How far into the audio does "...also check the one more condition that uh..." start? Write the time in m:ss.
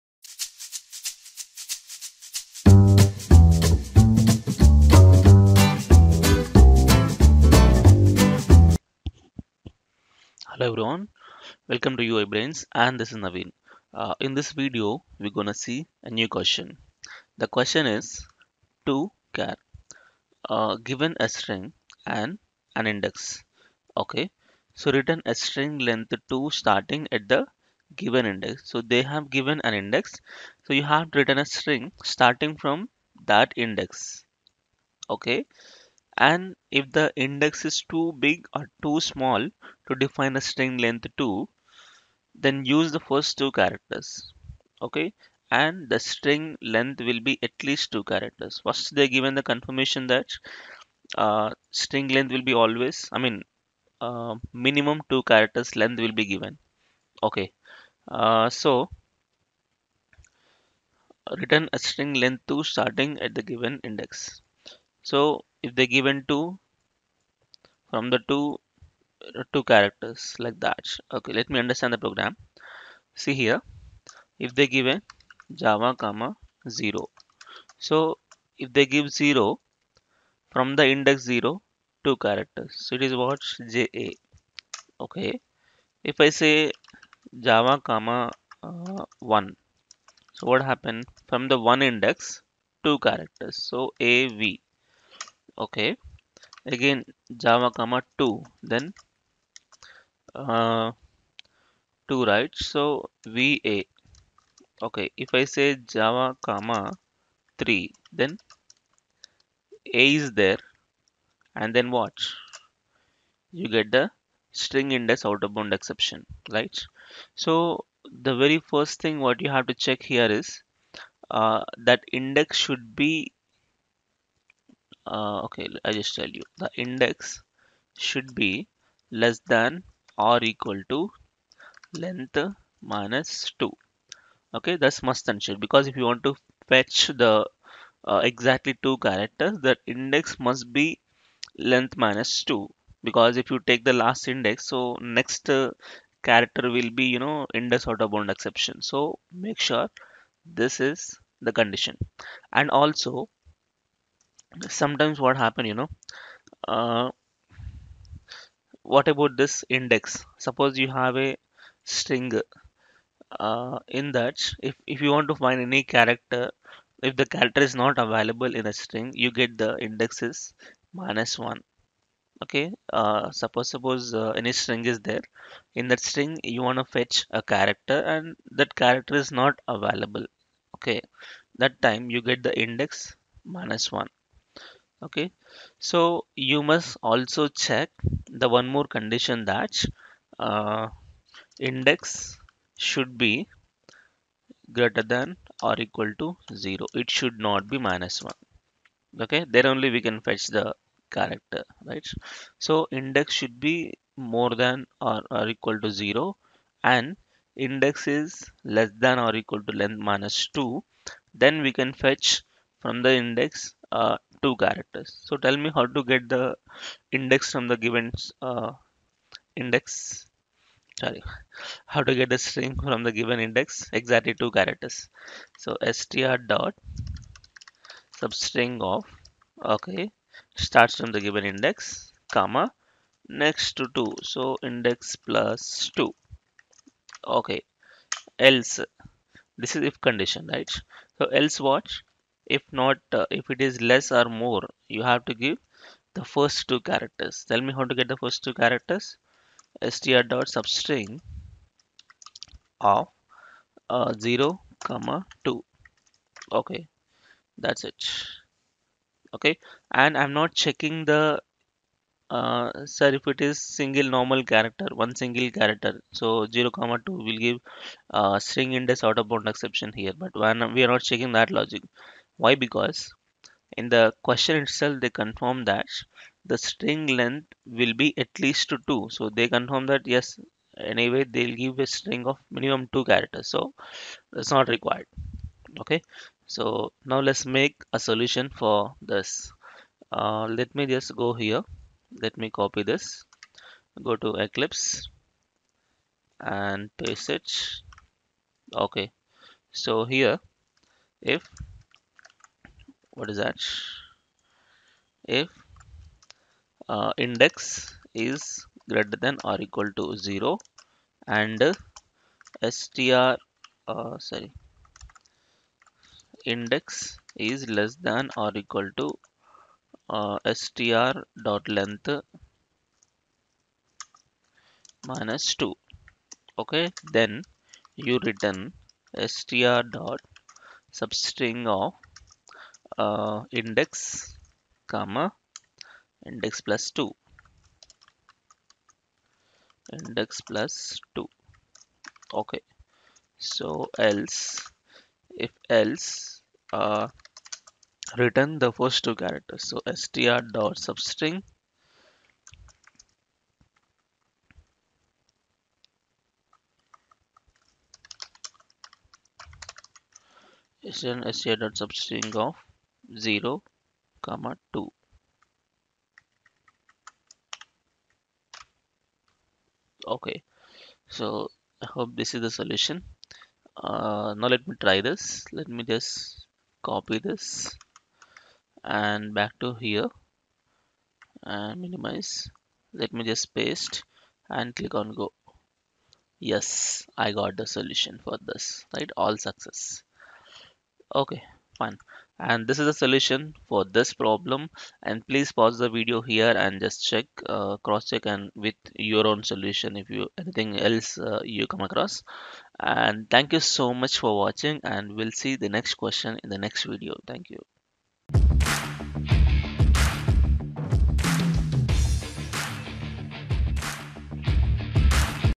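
3:07.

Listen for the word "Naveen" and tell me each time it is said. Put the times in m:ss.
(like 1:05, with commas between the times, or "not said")
0:13.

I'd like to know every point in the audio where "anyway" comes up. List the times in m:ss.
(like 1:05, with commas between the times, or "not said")
4:40.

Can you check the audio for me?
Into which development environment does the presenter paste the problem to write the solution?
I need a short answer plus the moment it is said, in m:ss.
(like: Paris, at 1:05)
Eclipse, at 4:54.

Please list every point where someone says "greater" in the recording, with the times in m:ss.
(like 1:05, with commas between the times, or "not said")
3:14, 5:08.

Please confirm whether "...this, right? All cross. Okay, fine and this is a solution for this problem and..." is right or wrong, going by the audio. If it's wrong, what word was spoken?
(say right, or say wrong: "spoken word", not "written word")
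wrong: "success", not "cross".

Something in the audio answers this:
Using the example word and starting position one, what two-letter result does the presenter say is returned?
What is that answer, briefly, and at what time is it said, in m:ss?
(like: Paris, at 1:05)
av, at 1:34.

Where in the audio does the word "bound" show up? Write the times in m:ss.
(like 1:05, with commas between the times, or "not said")
1:55, 2:28, 4:29.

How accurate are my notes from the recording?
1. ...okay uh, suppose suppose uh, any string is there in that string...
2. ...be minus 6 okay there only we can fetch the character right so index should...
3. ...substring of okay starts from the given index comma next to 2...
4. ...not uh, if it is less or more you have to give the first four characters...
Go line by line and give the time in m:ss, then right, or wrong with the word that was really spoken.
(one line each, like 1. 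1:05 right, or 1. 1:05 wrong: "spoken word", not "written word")
1. 2:52 right
2. 3:17 wrong: "1", not "6"
3. 3:48 right
4. 4:02 wrong: "two", not "four".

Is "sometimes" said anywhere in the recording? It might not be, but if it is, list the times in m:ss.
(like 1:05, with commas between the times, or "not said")
2:34.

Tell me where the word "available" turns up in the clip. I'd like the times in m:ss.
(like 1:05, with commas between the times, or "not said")
2:47, 2:59.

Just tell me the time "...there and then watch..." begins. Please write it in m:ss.
1:50.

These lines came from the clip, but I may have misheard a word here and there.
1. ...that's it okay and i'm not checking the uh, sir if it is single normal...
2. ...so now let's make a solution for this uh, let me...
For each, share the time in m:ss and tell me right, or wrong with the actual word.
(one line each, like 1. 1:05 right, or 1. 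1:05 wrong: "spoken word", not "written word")
1. 4:17 right
2. 4:46 right.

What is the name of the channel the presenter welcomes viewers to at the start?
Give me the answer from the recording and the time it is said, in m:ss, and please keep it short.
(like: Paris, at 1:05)
UI Brains, at 0:12.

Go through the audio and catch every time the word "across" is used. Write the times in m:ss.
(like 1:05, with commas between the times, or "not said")
6:41.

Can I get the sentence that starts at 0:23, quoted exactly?
Okay, so return a string length to starting at the given index.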